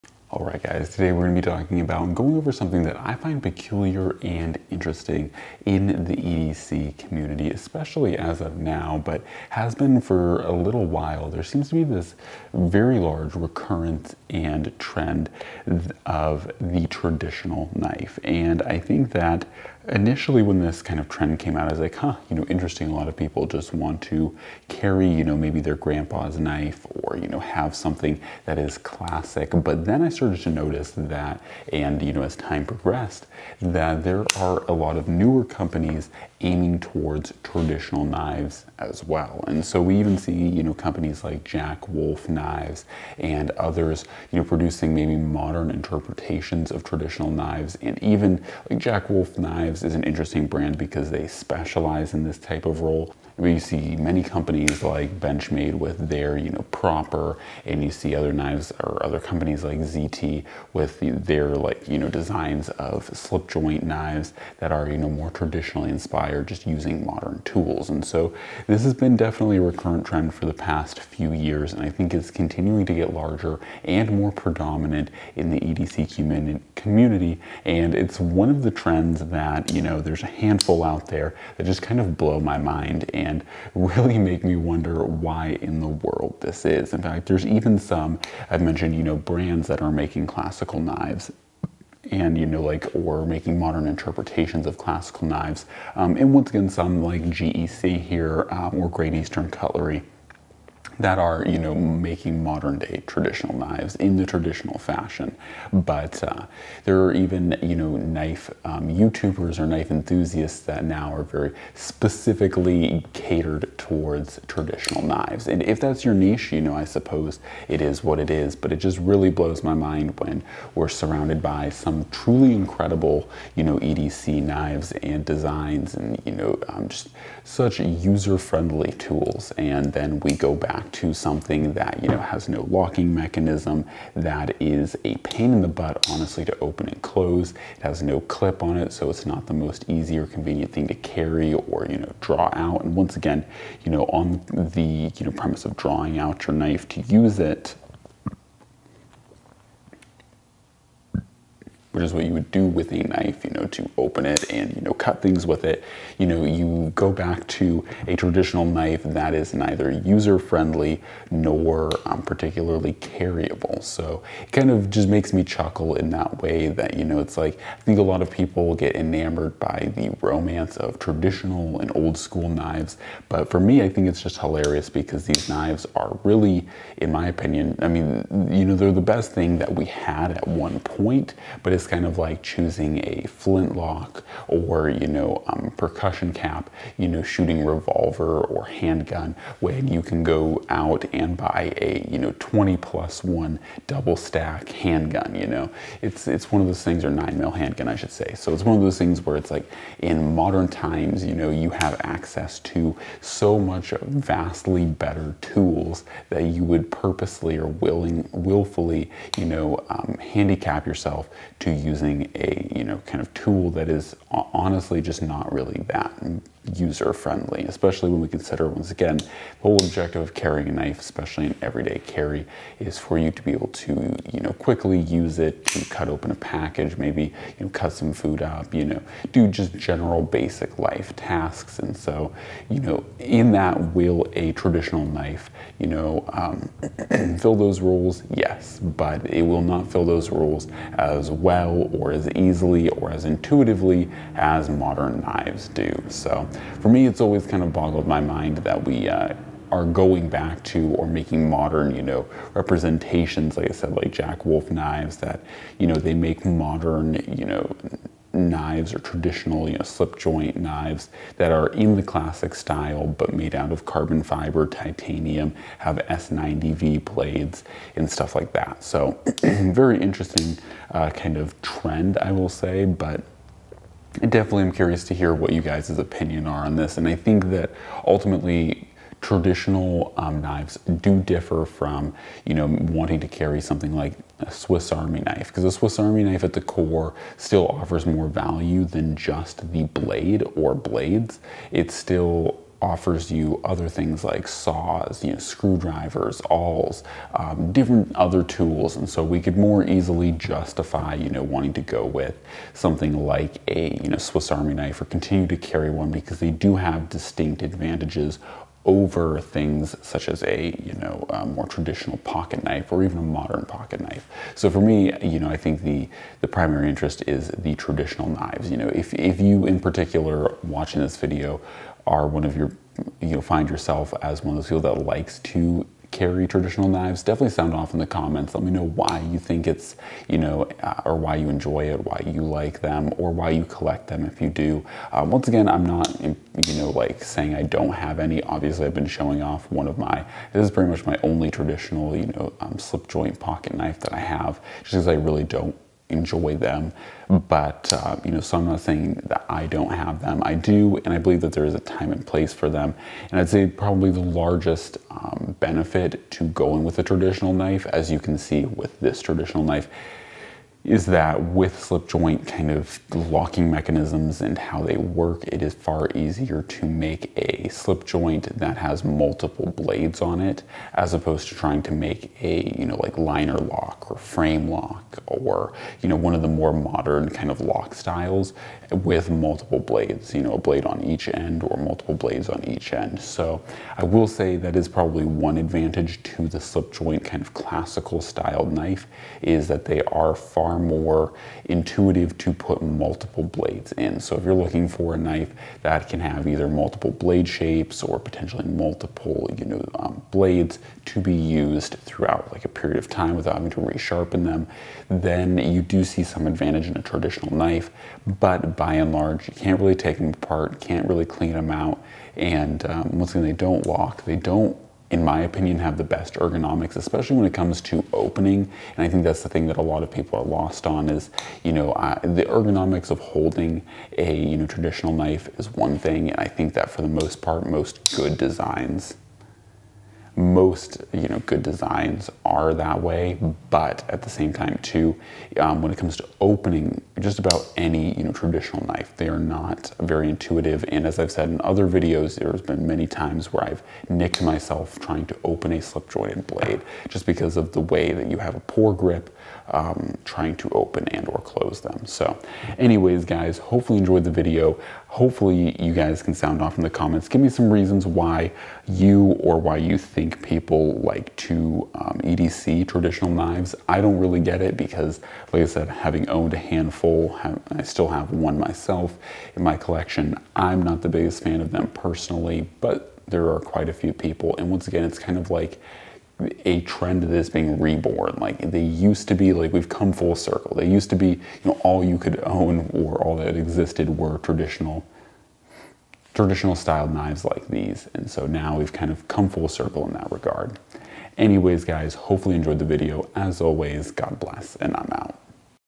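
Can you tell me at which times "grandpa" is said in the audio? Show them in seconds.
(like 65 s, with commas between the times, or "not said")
25 s.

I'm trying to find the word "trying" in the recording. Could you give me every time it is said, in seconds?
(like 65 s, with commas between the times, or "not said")
371 s, 444 s, 450 s.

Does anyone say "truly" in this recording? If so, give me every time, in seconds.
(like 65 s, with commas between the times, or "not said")
122 s.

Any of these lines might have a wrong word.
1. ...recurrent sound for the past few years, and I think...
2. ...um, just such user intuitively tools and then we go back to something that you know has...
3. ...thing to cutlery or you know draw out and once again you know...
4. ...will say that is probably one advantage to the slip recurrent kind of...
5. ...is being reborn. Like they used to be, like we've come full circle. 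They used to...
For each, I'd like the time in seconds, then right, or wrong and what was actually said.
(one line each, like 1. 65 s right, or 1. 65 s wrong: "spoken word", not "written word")
1. 69 s wrong: "trend", not "sound"
2. 126 s wrong: "friendly", not "intuitively"
3. 140 s wrong: "carry", not "cutlery"
4. 384 s wrong: "joint", not "recurrent"
5. 477 s right.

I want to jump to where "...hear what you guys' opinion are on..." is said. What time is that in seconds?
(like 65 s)
275 s.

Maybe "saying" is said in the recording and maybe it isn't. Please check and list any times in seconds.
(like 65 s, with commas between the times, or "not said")
337 s, 348 s.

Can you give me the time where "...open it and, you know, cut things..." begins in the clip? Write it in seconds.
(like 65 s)
153 s.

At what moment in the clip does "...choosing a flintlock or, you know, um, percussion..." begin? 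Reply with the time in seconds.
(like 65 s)
182 s.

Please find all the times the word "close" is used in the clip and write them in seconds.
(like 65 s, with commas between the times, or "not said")
137 s, 451 s.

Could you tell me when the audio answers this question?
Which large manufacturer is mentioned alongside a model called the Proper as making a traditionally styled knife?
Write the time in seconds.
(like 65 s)
55 s.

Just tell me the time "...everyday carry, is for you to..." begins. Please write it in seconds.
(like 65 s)
221 s.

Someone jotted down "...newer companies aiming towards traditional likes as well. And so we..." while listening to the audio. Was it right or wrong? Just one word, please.
wrong.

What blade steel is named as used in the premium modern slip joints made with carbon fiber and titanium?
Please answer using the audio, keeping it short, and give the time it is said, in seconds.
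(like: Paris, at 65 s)
S90V, at 265 s.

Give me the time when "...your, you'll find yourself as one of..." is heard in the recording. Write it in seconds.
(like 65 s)
322 s.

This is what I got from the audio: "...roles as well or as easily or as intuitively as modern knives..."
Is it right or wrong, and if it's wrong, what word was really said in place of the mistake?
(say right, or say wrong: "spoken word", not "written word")
right.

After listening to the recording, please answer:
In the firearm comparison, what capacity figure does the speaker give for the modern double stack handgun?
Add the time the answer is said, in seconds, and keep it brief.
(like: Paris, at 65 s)
20 plus one, at 192 s.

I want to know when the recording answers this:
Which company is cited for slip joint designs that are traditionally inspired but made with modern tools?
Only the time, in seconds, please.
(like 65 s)
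59 s.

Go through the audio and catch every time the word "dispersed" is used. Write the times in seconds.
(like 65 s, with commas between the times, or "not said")
not said.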